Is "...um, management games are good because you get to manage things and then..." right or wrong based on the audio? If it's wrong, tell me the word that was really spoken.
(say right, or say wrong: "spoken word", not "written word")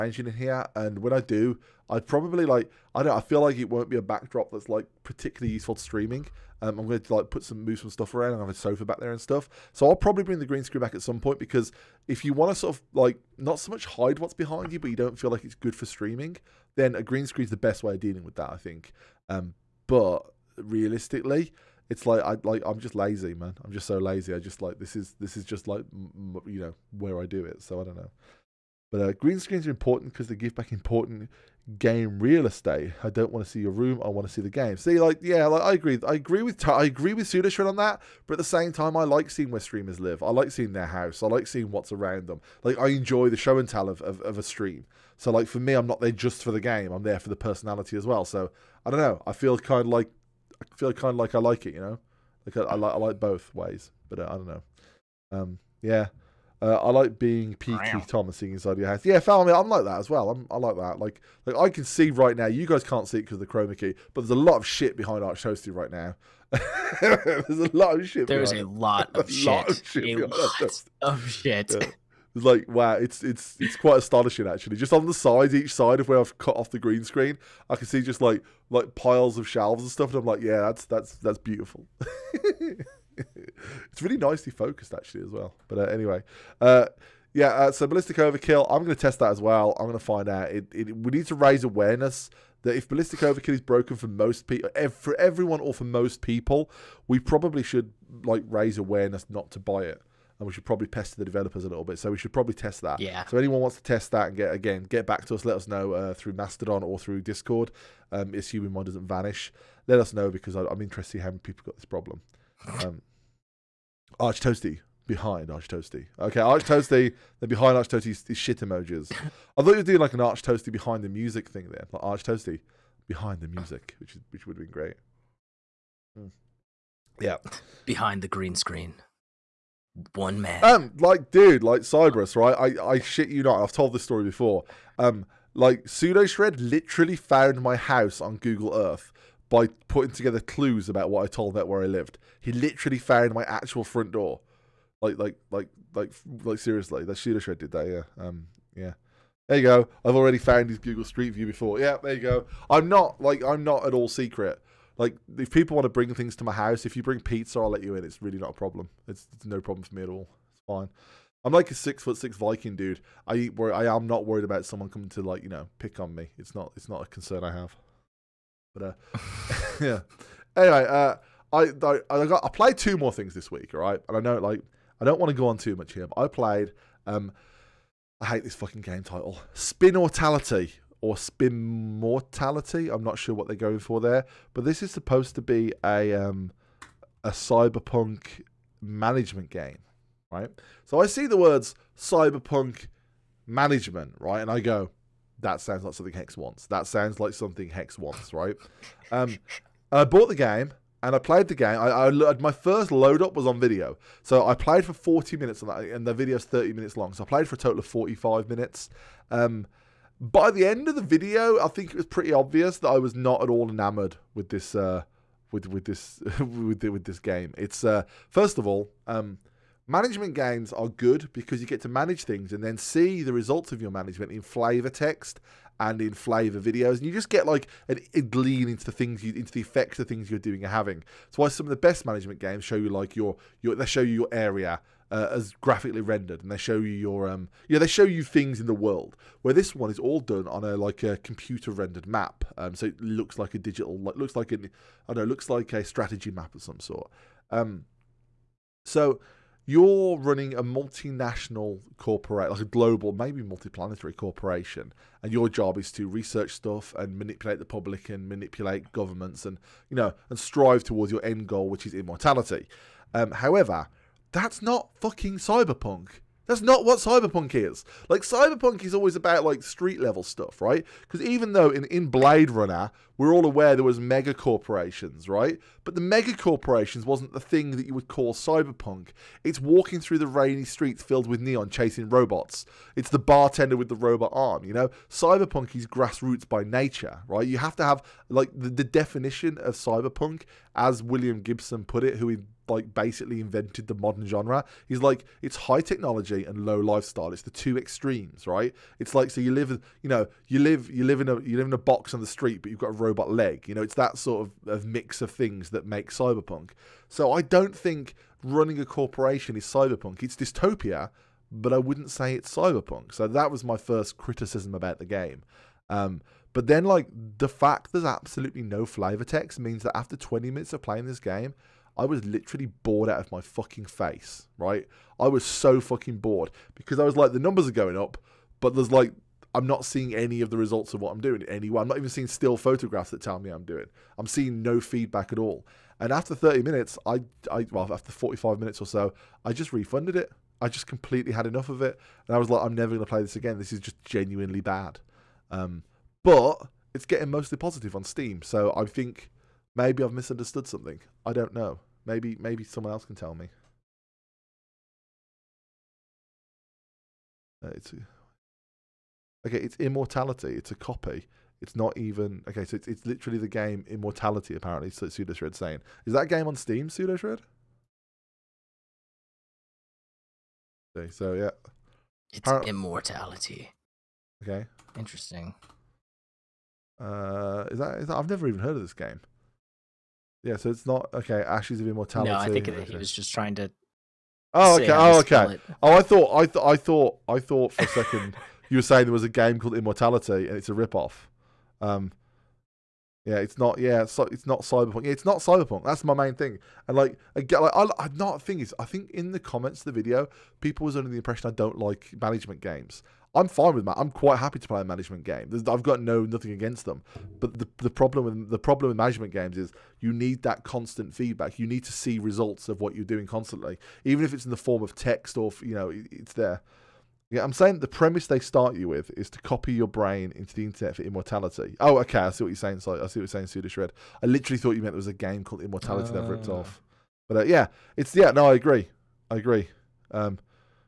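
right.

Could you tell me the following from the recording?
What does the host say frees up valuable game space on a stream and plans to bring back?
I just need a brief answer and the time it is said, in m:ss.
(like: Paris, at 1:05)
Green screens, at 0:29.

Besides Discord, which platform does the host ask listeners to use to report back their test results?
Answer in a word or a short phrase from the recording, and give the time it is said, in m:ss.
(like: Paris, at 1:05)
Mastodon, at 1:46.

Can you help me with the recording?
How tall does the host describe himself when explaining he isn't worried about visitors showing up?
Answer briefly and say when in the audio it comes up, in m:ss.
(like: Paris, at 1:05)
six foot six, at 2:41.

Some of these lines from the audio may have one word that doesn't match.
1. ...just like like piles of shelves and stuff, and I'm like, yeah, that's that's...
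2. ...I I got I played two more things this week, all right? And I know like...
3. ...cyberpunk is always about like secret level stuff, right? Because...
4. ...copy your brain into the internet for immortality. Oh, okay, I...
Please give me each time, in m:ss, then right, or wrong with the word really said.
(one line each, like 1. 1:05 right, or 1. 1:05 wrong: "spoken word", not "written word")
1. 1:18 right
2. 2:51 right
3. 4:28 wrong: "street", not "secret"
4. 6:59 right.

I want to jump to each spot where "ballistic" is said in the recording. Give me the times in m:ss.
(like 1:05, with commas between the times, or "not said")
1:27, 1:32.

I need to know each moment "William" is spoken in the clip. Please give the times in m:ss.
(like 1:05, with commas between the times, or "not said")
4:51.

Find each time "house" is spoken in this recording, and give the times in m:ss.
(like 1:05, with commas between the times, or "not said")
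0:40, 0:58, 2:17, 2:36.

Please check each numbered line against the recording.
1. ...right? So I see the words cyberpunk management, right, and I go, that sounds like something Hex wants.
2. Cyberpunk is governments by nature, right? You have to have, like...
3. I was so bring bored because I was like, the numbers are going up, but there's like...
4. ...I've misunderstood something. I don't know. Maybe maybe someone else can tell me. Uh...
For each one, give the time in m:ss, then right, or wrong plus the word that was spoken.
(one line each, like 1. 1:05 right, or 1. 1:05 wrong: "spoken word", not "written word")
1. 3:10 right
2. 4:45 wrong: "grassroots", not "governments"
3. 5:25 wrong: "fucking", not "bring"
4. 5:50 right.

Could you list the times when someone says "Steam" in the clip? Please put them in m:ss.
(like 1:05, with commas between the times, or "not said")
5:48, 6:06.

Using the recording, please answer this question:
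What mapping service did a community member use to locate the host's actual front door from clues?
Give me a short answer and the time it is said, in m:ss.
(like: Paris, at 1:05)
Google Earth, at 2:18.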